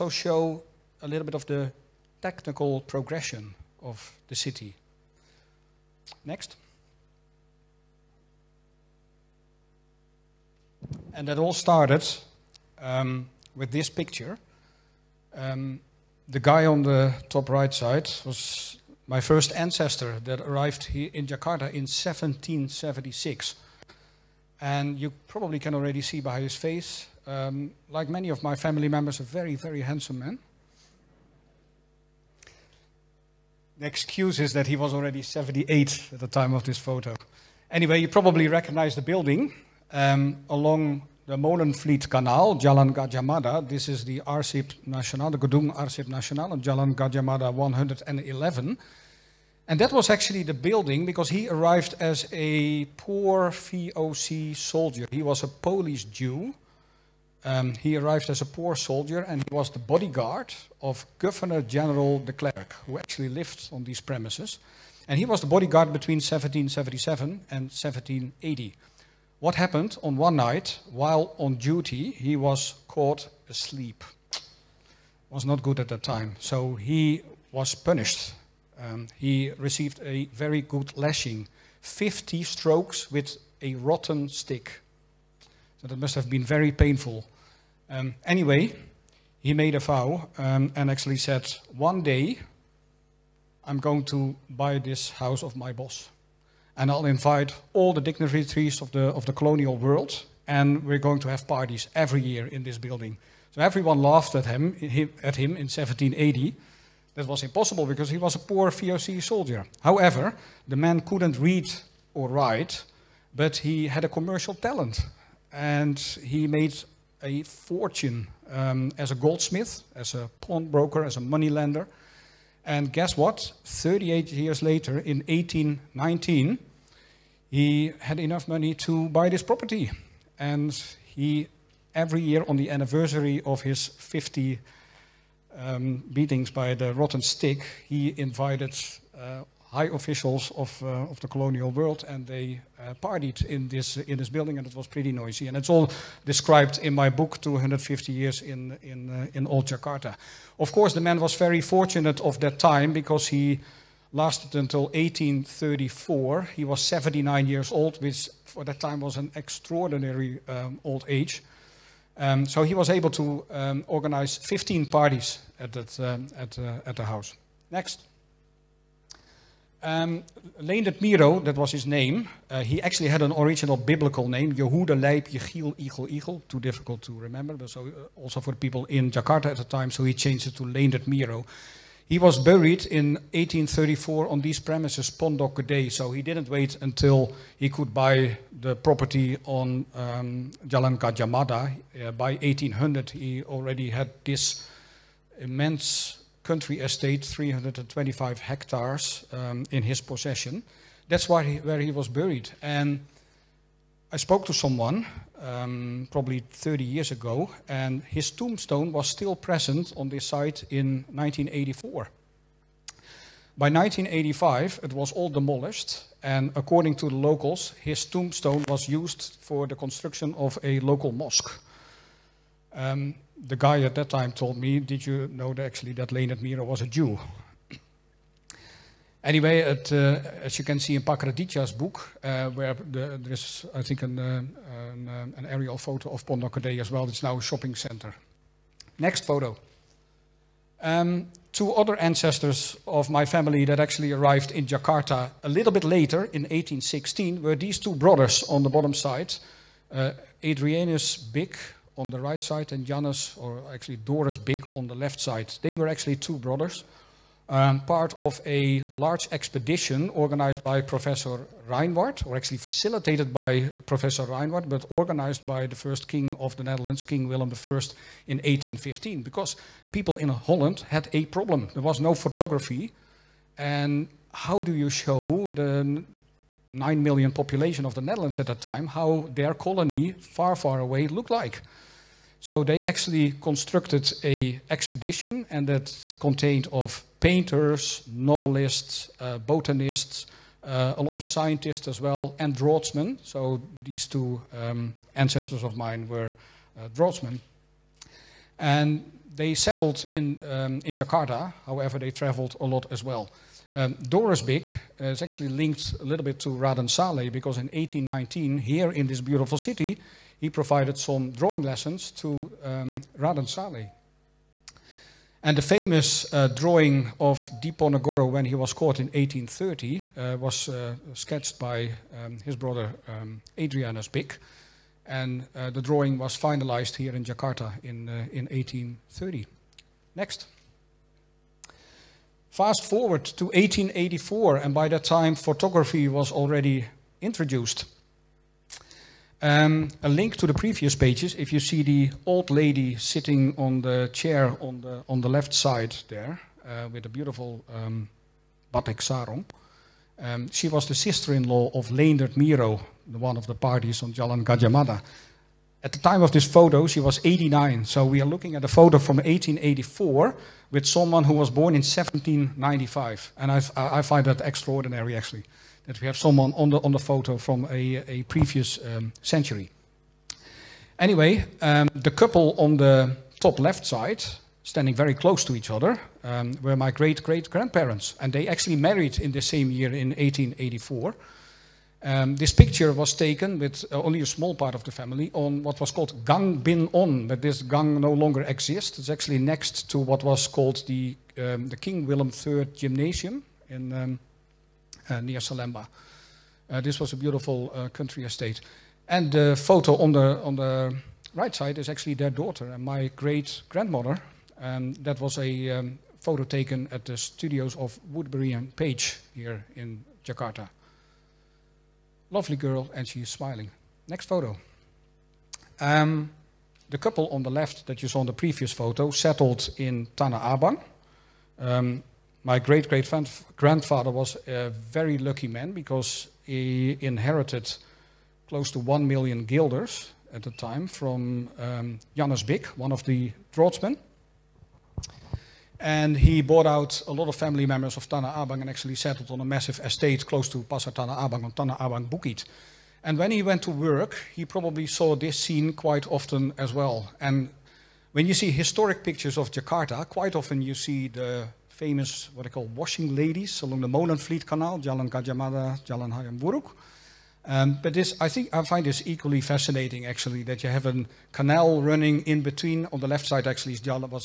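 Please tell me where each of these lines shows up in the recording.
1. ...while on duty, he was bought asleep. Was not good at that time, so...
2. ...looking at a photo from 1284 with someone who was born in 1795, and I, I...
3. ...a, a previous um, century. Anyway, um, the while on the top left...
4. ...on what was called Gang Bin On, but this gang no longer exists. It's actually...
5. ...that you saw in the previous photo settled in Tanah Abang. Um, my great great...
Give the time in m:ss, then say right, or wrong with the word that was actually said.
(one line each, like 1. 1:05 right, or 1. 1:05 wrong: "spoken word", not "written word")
1. 1:10 wrong: "caught", not "bought"
2. 5:58 wrong: "1884", not "1284"
3. 6:07 wrong: "couple", not "while"
4. 6:25 right
5. 6:57 right.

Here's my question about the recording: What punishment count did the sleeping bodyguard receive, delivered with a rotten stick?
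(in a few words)
50 strokes.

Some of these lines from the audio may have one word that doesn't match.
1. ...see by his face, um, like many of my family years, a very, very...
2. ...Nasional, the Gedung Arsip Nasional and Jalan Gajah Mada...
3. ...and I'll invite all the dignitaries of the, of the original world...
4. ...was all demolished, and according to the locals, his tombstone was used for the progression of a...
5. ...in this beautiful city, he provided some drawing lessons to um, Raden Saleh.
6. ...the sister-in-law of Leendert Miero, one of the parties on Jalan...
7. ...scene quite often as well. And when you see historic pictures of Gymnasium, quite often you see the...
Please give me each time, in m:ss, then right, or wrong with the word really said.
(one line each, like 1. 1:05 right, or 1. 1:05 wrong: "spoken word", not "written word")
1. 0:26 wrong: "members", not "years"
2. 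0:44 right
3. 1:36 wrong: "colonial", not "original"
4. 3:34 wrong: "construction", not "progression"
5. 5:08 right
6. 5:50 right
7. 7:25 wrong: "Jakarta", not "Gymnasium".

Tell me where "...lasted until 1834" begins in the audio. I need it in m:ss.
2:34.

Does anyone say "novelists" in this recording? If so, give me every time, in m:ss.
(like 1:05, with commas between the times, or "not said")
4:48.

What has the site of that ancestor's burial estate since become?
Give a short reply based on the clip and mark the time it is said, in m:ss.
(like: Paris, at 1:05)
a shopping center, at 3:57.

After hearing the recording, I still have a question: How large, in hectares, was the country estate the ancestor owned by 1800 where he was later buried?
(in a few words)
325 hectares.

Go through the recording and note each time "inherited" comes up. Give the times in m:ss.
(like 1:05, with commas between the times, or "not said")
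7:07.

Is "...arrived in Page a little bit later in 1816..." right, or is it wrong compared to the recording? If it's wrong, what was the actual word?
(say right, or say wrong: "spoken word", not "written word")
wrong: "Jakarta", not "Page".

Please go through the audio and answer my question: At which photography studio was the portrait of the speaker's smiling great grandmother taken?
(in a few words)
Woodbury and Page.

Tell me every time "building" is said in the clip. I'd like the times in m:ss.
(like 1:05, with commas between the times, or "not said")
0:39, 0:50, 1:42, 2:24.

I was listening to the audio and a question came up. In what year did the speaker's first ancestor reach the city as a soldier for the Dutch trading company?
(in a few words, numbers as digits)
1776.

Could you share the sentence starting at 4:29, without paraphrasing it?
Because people in Holland had a problem.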